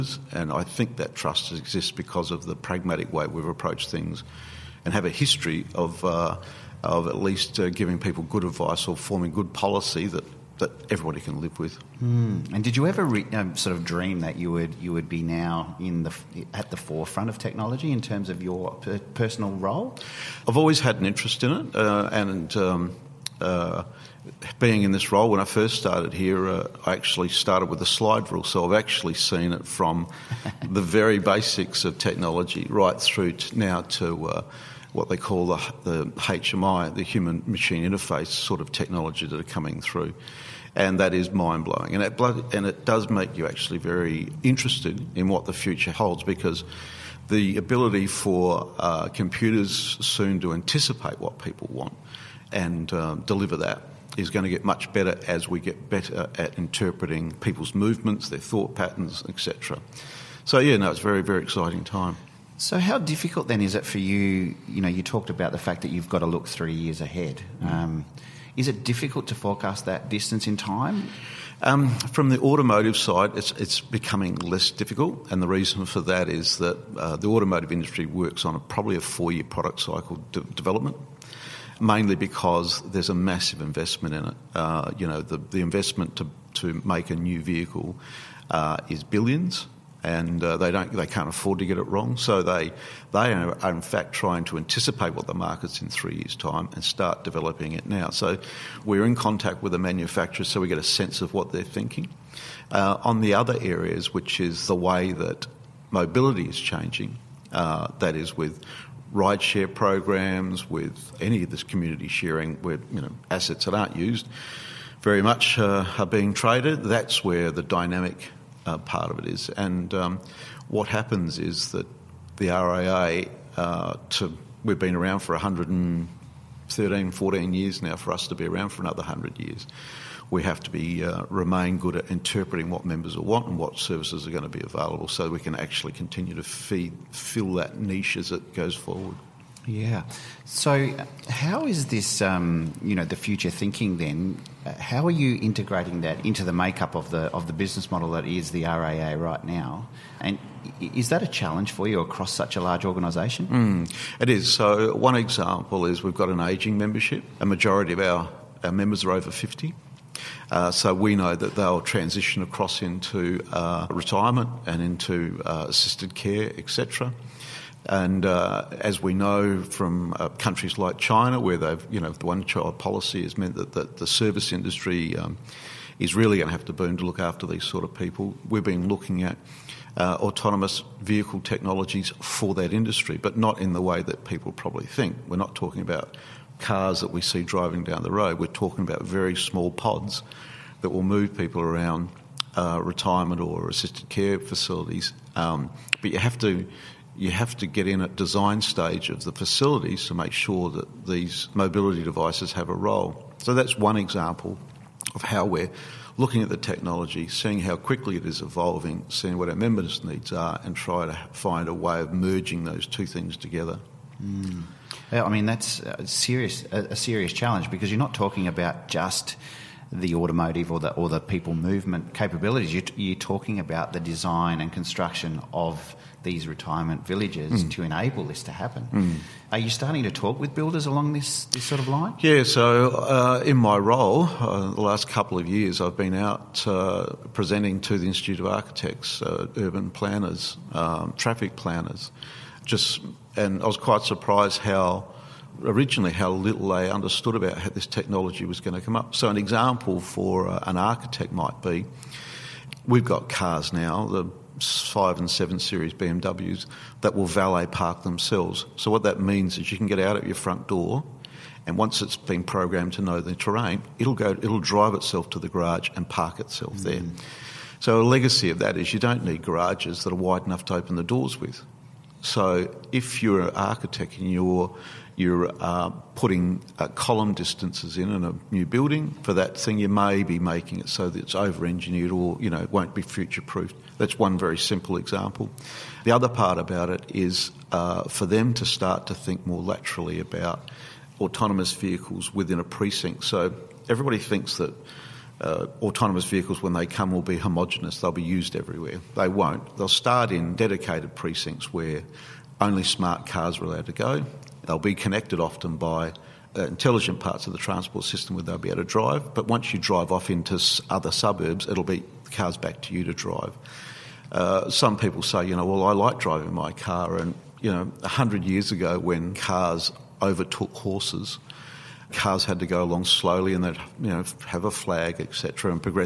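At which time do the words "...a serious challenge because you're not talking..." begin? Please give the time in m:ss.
3:36.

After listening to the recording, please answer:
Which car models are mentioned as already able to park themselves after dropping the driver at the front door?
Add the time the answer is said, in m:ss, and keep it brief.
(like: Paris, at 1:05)
BMW 5 and 7 Series, at 4:14.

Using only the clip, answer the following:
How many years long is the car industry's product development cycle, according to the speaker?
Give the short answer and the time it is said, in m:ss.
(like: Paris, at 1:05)
4 years, at 1:19.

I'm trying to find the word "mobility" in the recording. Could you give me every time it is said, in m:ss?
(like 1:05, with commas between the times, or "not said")
1:45, 3:21.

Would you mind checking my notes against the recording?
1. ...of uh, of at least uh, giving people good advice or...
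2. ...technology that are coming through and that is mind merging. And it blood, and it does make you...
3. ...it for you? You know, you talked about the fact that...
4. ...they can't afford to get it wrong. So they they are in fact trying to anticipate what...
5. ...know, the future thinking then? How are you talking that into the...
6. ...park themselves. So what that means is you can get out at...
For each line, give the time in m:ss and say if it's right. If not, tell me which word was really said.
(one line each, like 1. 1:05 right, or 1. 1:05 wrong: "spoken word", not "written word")
1. 0:05 right
2. 0:38 wrong: "blowing", not "merging"
3. 1:03 right
4. 1:30 right
5. 2:22 wrong: "integrating", not "talking"
6. 4:17 right.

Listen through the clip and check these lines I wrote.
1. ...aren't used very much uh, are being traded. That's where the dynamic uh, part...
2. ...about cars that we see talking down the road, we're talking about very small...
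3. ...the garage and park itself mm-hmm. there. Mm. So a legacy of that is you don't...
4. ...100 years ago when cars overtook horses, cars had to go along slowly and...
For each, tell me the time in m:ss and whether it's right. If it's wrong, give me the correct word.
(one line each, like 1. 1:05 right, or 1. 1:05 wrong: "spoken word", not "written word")
1. 1:53 right
2. 3:05 wrong: "driving", not "talking"
3. 4:25 right
4. 5:18 right.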